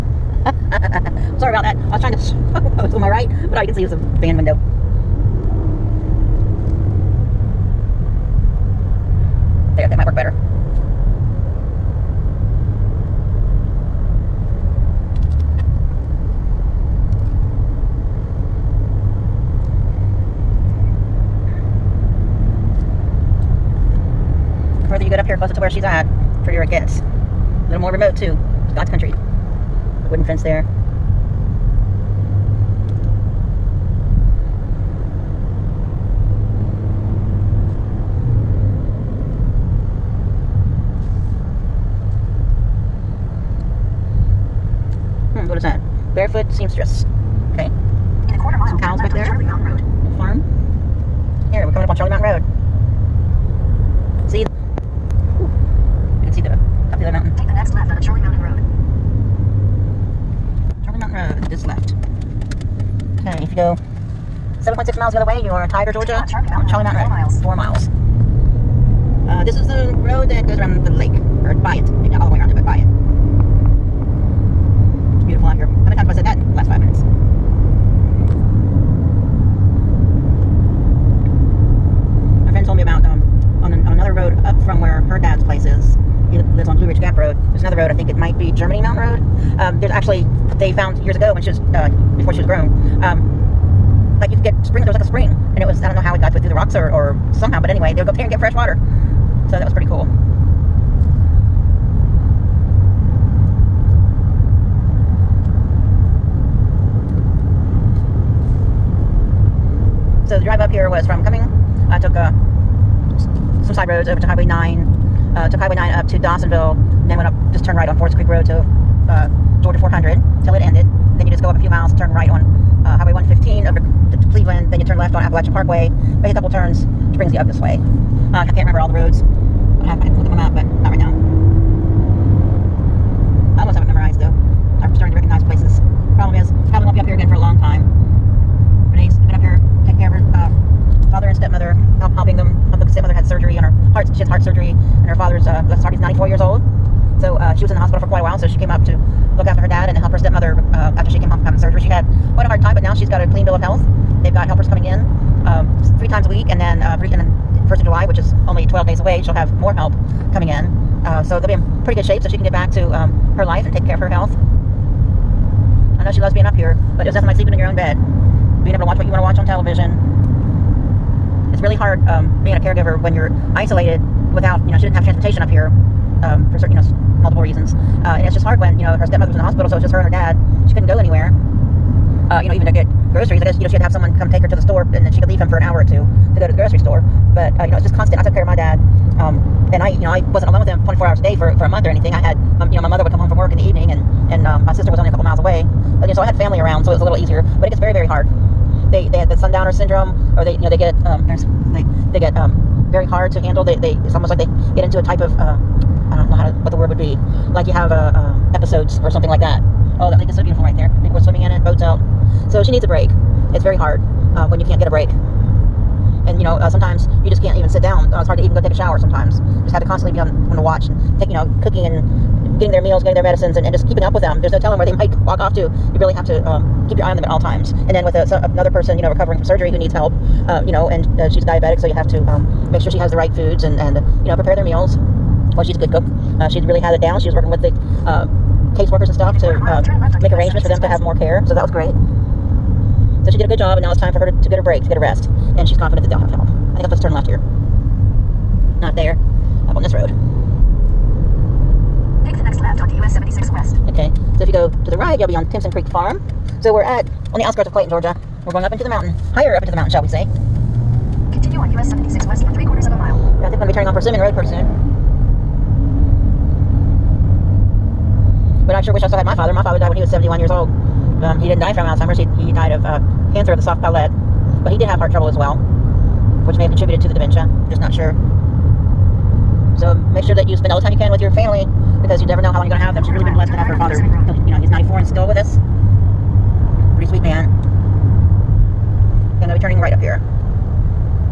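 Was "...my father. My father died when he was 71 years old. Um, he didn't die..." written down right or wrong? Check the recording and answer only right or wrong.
right.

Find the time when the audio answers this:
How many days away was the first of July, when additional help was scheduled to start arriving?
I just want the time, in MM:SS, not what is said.
02:38.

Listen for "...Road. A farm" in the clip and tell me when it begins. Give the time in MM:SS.
00:49.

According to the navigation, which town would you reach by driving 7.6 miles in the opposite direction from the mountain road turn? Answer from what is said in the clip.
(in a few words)
Tiger, Georgia.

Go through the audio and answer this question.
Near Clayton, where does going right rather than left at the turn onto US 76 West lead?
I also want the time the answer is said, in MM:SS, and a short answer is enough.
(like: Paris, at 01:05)
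Timpson Creek Farm, at 04:15.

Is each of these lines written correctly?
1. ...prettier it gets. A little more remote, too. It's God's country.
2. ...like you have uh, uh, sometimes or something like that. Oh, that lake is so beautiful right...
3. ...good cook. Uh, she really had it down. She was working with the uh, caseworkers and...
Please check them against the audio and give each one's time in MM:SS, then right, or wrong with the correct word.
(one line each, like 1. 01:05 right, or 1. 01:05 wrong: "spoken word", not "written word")
1. 00:26 right
2. 03:27 wrong: "episodes", not "sometimes"
3. 03:55 right.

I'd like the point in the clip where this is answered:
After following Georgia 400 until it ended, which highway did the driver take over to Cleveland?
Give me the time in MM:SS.
02:02.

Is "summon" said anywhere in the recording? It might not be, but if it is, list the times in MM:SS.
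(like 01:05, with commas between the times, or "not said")
not said.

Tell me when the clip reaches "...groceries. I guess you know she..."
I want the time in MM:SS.
03:03.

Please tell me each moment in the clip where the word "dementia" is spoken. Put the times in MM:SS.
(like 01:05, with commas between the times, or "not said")
04:37.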